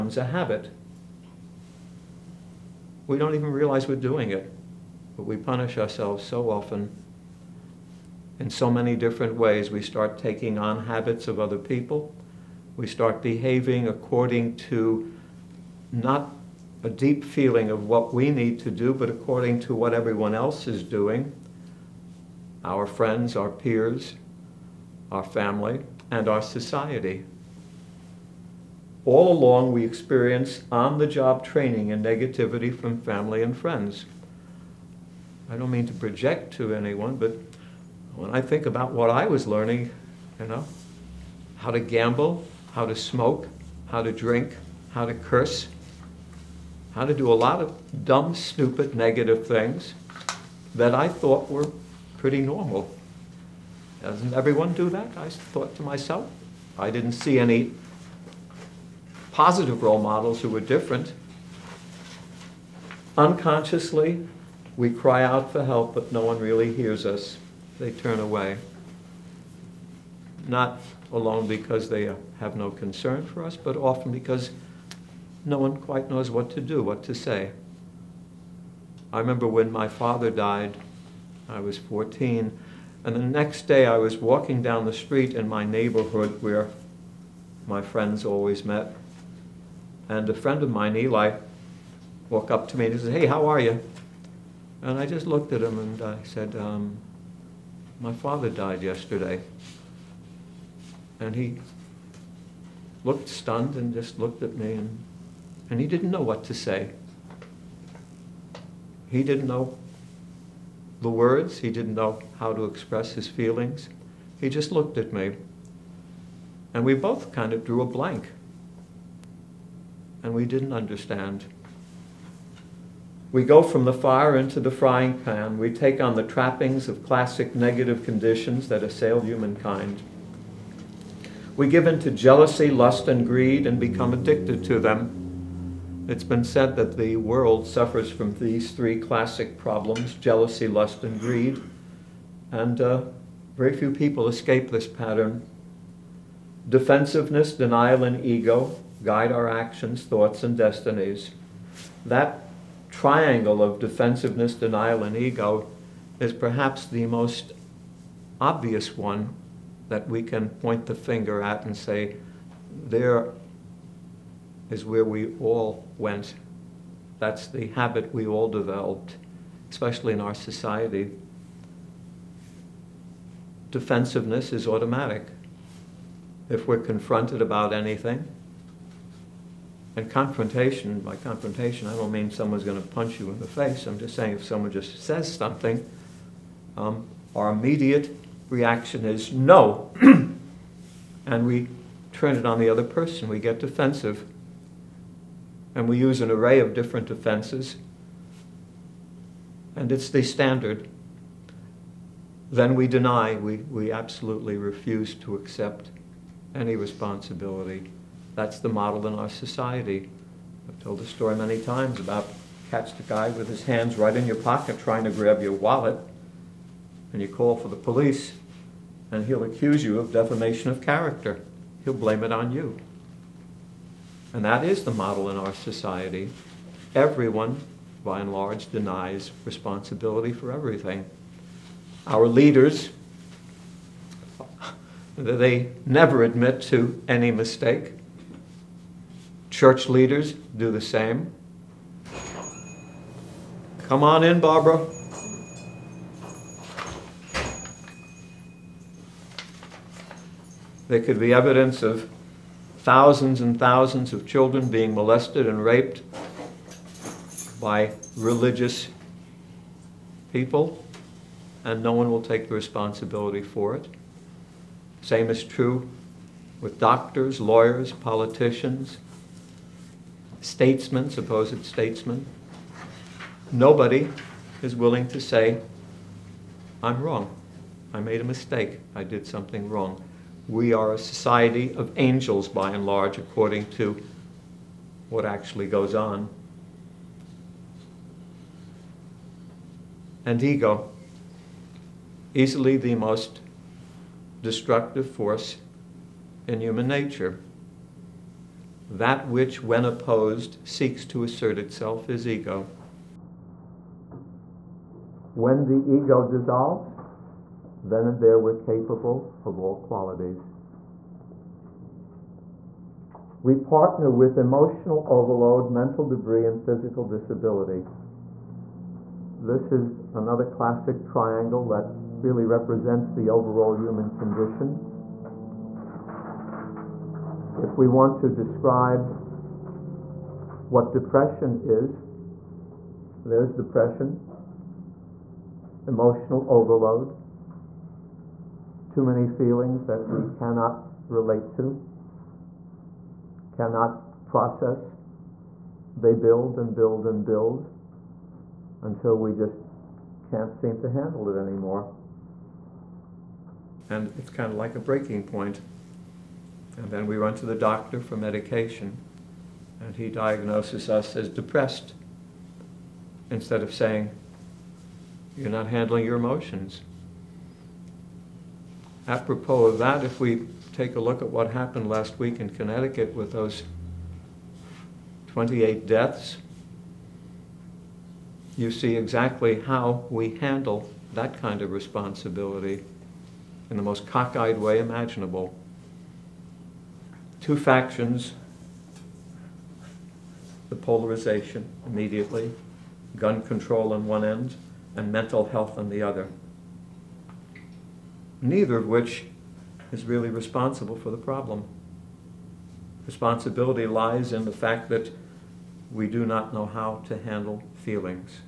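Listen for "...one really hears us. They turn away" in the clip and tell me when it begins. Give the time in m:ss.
1:06.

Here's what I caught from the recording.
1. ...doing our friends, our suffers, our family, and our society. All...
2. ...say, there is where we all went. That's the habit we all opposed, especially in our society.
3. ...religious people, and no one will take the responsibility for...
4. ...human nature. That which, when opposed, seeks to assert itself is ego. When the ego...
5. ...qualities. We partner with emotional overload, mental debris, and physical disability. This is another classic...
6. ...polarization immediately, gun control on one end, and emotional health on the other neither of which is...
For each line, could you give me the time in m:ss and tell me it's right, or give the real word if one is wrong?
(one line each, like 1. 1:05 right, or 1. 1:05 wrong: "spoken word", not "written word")
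1. 0:20 wrong: "peers", not "suffers"
2. 2:41 wrong: "developed", not "opposed"
3. 4:18 right
4. 4:56 right
5. 5:09 right
6. 6:30 wrong: "mental", not "emotional".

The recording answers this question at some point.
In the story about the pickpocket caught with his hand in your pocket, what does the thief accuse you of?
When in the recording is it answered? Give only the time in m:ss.
3:40.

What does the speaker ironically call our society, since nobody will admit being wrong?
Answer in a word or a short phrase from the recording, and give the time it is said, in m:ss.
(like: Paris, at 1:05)
a society of angels, at 4:40.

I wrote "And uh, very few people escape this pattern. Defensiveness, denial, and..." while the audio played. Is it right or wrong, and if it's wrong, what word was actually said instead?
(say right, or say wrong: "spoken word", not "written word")
right.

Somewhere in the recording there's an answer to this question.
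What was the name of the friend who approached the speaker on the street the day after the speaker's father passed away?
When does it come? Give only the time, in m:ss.
1:30.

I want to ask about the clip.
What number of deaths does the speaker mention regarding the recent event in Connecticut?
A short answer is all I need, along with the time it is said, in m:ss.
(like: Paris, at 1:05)
28, at 6:15.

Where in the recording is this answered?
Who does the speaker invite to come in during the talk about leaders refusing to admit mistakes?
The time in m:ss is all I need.
4:04.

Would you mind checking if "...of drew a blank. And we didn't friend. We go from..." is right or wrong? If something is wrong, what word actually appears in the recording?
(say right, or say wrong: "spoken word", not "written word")
wrong: "understand", not "friend".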